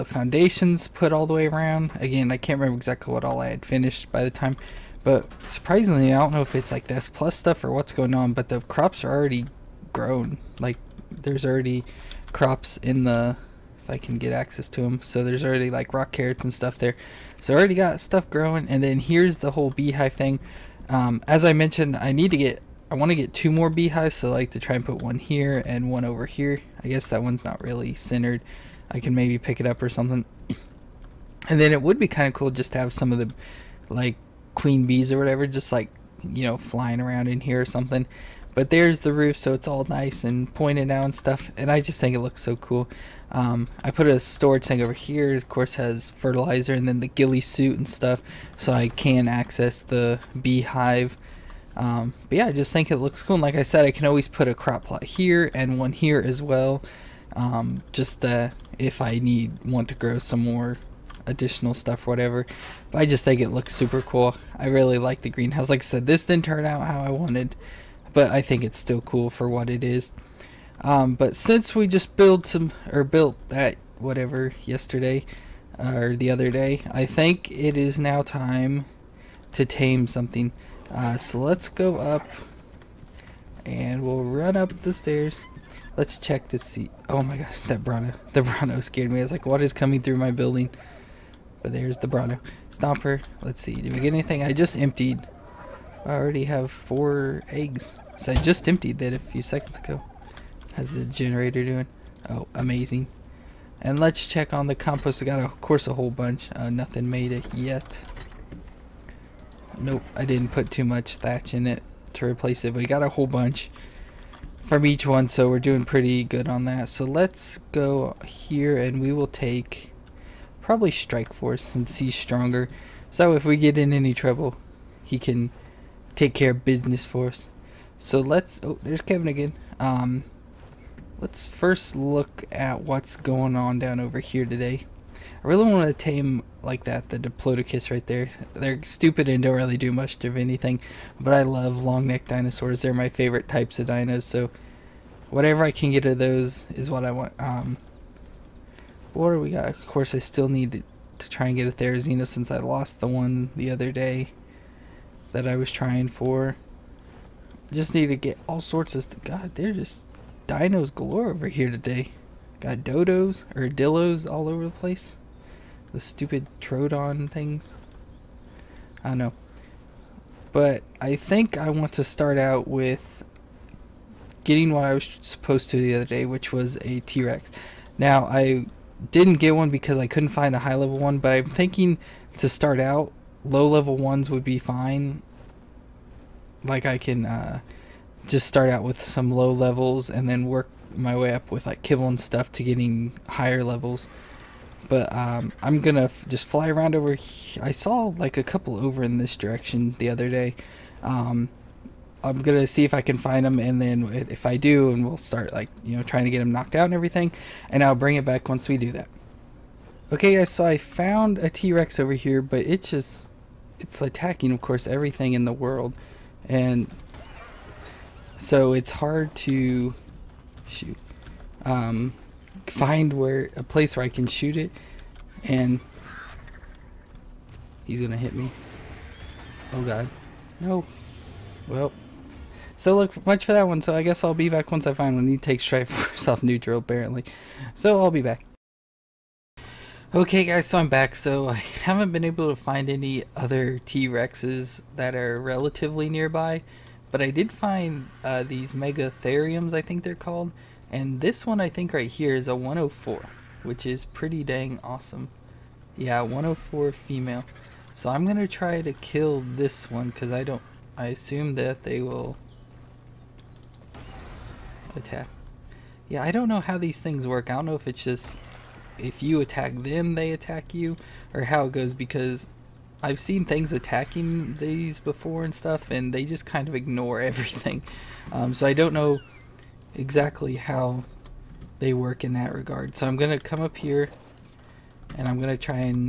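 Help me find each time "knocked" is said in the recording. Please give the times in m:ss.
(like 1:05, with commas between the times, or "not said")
3:26.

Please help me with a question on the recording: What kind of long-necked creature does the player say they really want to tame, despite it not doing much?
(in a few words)
Diplodocus.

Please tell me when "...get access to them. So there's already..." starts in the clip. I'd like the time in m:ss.
0:14.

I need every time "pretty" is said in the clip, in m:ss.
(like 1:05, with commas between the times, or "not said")
1:55, 4:14.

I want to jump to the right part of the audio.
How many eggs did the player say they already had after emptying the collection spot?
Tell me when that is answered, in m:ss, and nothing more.
1:36.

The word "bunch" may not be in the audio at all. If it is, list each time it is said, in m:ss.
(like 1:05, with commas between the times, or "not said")
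1:46, 1:53.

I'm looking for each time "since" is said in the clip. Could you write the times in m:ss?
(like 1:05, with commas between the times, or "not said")
1:11, 2:01, 2:32.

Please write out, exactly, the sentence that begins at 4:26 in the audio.
Yeah, I don't know how these things work.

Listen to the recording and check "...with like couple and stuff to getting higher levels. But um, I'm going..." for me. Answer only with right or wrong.
wrong.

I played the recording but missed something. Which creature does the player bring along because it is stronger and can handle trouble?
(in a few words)
Strike Force.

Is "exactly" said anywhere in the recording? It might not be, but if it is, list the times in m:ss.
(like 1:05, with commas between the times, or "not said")
0:02, 4:39.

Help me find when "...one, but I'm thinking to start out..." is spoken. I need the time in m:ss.
3:00.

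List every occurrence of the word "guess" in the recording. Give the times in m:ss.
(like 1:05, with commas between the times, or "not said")
0:26, 3:54.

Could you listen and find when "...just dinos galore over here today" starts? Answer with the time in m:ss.
2:39.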